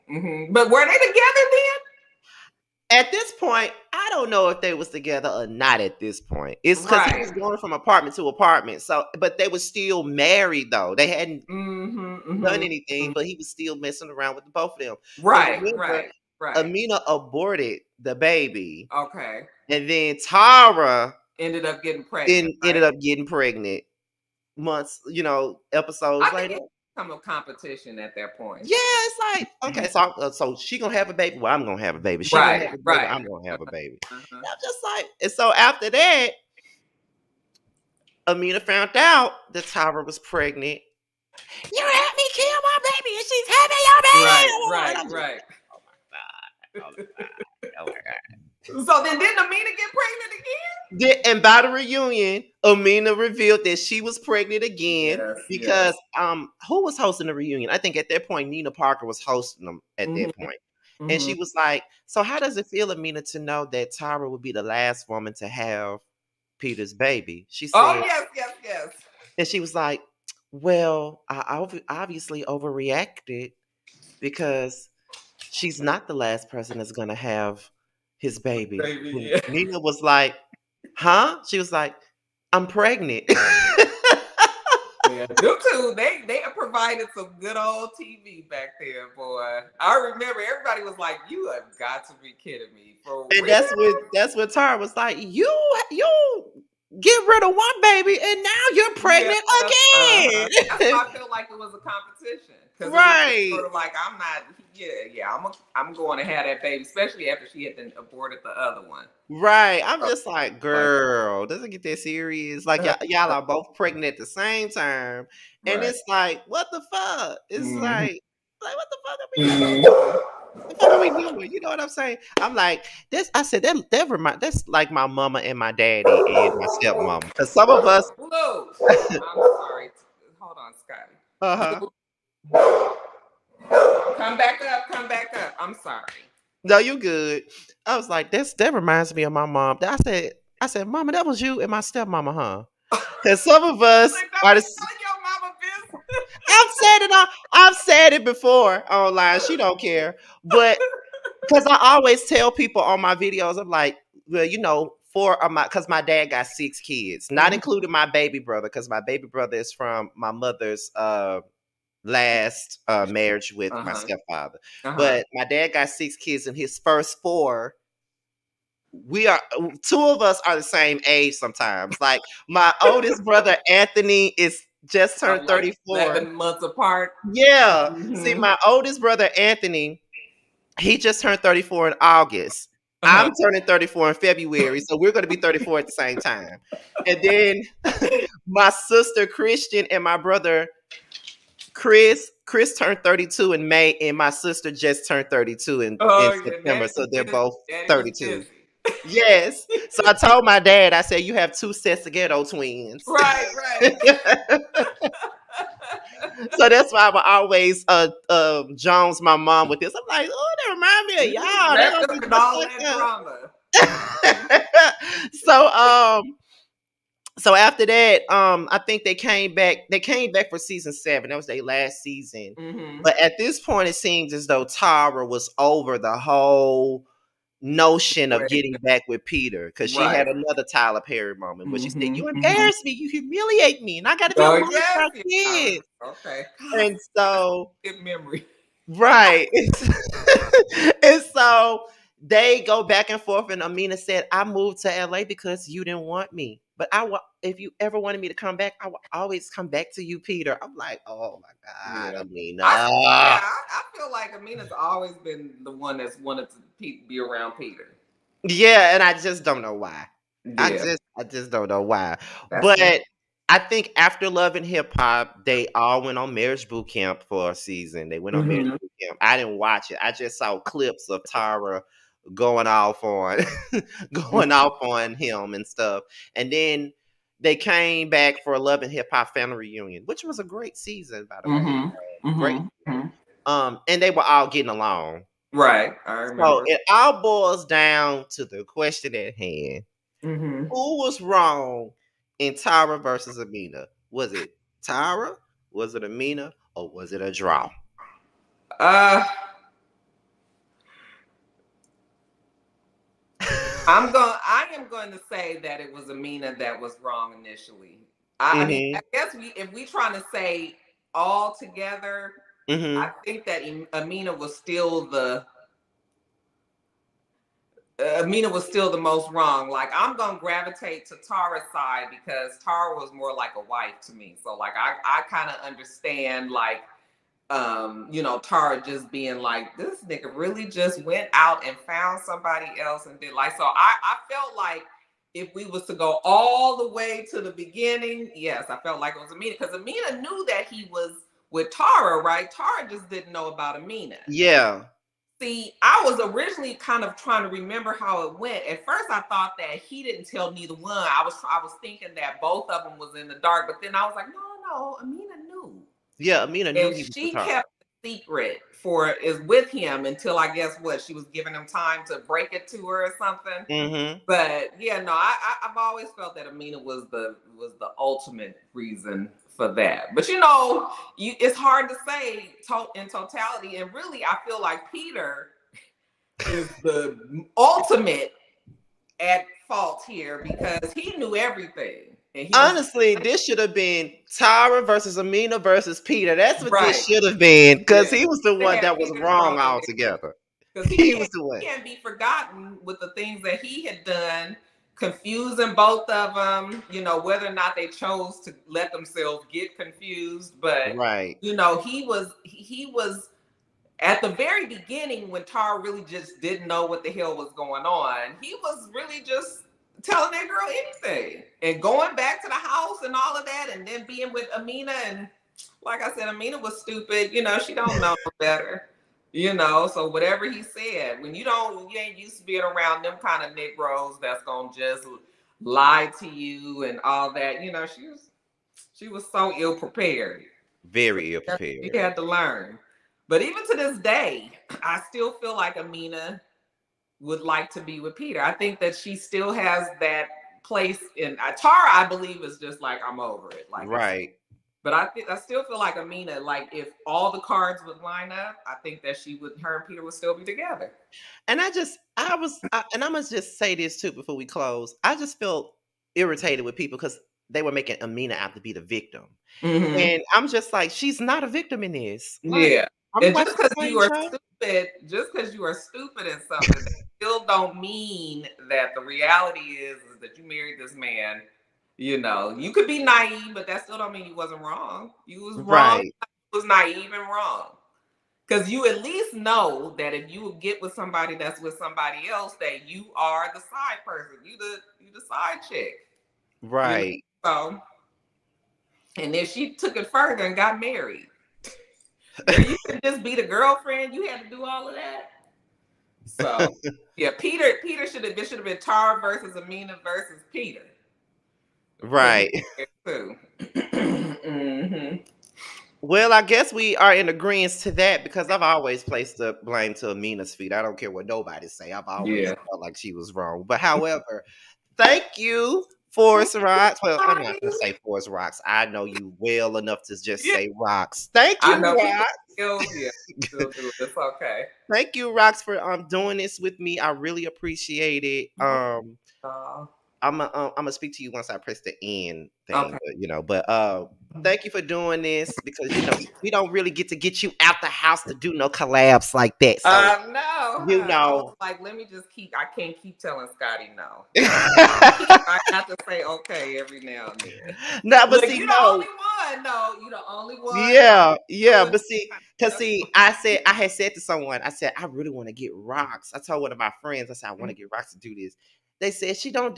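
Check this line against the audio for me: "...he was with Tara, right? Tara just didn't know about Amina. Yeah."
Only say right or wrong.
right.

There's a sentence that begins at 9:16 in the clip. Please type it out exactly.
I told one of my friends, I said I want to mm-hmm.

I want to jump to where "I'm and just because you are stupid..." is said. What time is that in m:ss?
7:43.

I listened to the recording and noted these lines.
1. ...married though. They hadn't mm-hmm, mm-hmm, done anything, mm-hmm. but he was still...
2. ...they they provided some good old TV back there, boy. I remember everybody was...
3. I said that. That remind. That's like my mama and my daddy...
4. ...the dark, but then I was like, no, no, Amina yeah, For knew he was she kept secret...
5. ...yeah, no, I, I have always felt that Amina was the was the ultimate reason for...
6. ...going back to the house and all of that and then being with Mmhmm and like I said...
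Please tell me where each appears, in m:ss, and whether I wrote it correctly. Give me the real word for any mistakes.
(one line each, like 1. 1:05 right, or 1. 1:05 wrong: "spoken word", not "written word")
1. 0:10 right
2. 1:25 right
3. 2:03 right
4. 5:53 wrong: "Amina", not "For"
5. 6:04 right
6. 6:51 wrong: "Amina", not "Mmhmm".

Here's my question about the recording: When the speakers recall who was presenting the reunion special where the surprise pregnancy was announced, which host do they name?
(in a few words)
Nina Parker.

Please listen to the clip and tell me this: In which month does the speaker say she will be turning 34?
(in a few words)
February.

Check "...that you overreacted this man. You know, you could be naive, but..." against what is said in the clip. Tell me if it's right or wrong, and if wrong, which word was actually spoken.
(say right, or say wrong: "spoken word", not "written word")
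wrong: "married", not "overreacted".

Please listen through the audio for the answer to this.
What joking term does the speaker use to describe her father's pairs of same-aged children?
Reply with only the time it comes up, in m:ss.
3:22.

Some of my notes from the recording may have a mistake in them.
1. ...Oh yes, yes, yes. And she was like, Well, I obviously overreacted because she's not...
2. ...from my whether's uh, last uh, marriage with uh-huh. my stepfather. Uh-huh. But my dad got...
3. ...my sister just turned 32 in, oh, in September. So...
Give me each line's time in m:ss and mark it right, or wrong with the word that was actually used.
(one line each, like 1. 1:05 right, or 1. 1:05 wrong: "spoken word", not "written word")
1. 1:08 right
2. 2:39 wrong: "mother", not "whether"
3. 3:14 right.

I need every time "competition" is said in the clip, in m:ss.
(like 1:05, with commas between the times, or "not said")
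0:27, 1:41.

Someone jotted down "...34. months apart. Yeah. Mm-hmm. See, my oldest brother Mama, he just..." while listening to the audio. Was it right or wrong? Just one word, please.
wrong.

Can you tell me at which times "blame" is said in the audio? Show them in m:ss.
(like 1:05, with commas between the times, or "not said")
8:29.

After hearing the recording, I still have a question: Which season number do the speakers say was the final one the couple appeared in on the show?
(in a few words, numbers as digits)
7.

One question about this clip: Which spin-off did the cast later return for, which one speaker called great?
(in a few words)
Love and Hip Hop Family Reunion.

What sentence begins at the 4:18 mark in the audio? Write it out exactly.
Yeah, and I just don't know why.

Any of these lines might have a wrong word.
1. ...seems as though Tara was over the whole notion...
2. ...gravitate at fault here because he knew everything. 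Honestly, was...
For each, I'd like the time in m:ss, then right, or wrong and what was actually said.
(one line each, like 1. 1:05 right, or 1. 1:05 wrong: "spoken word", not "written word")
1. 3:43 right
2. 6:17 wrong: "ultimate", not "gravitate".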